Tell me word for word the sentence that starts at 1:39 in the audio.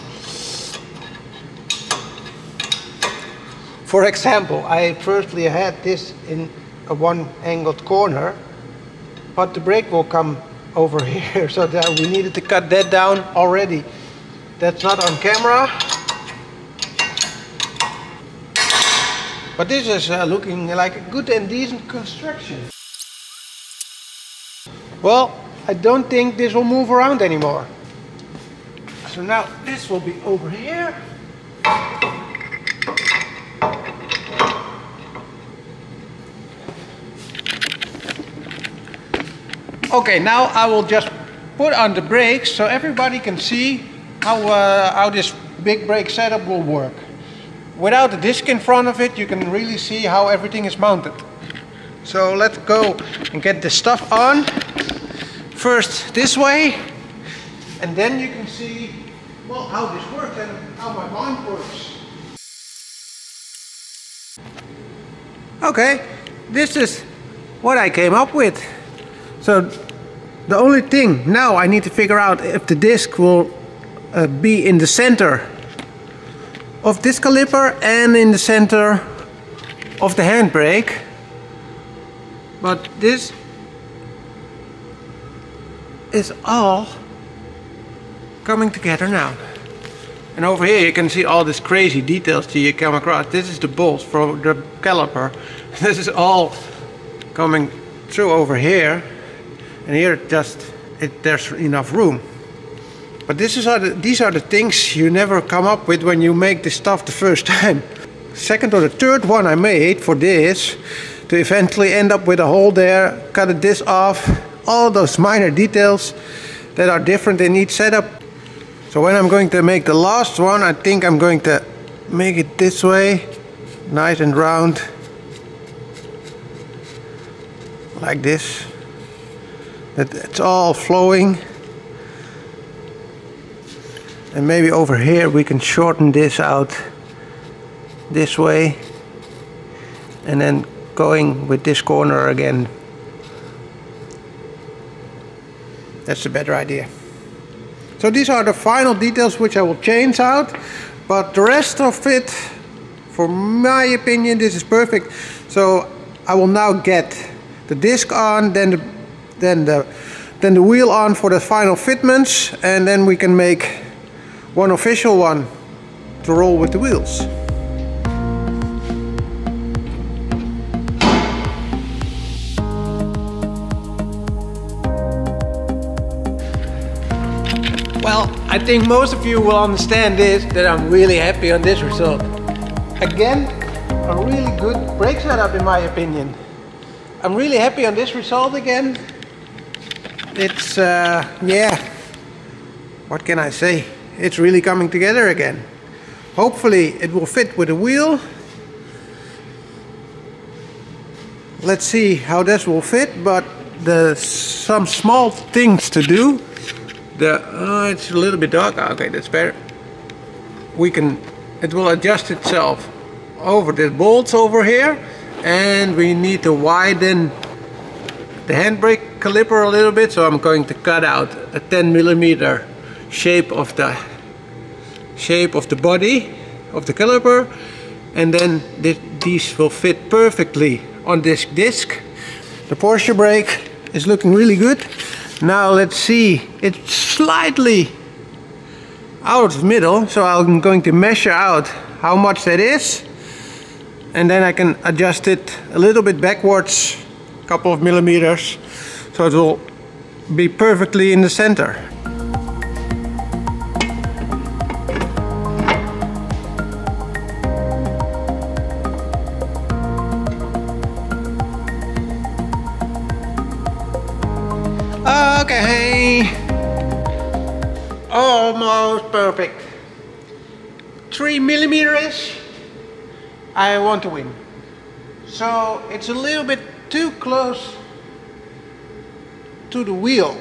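And here just, it, there's enough room.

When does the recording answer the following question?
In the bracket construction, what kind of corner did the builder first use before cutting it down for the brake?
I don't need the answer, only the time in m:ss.
0:06.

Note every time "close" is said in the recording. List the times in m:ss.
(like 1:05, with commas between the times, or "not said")
4:37.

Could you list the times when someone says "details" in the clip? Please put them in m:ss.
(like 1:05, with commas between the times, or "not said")
1:32, 1:55, 2:28.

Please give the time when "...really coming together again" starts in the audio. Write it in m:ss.
3:14.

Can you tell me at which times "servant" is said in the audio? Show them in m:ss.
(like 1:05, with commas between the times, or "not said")
not said.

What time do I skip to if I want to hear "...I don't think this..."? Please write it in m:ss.
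0:25.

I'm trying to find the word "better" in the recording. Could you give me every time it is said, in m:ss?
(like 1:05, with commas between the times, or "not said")
2:26, 3:29.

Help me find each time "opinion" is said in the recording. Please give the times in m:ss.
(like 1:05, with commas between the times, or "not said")
2:33, 3:05.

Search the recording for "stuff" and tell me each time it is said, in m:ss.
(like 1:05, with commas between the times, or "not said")
0:53, 1:46.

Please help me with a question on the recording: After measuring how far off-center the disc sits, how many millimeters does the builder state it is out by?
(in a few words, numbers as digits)
3.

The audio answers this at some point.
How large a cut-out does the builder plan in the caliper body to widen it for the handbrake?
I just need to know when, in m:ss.
3:41.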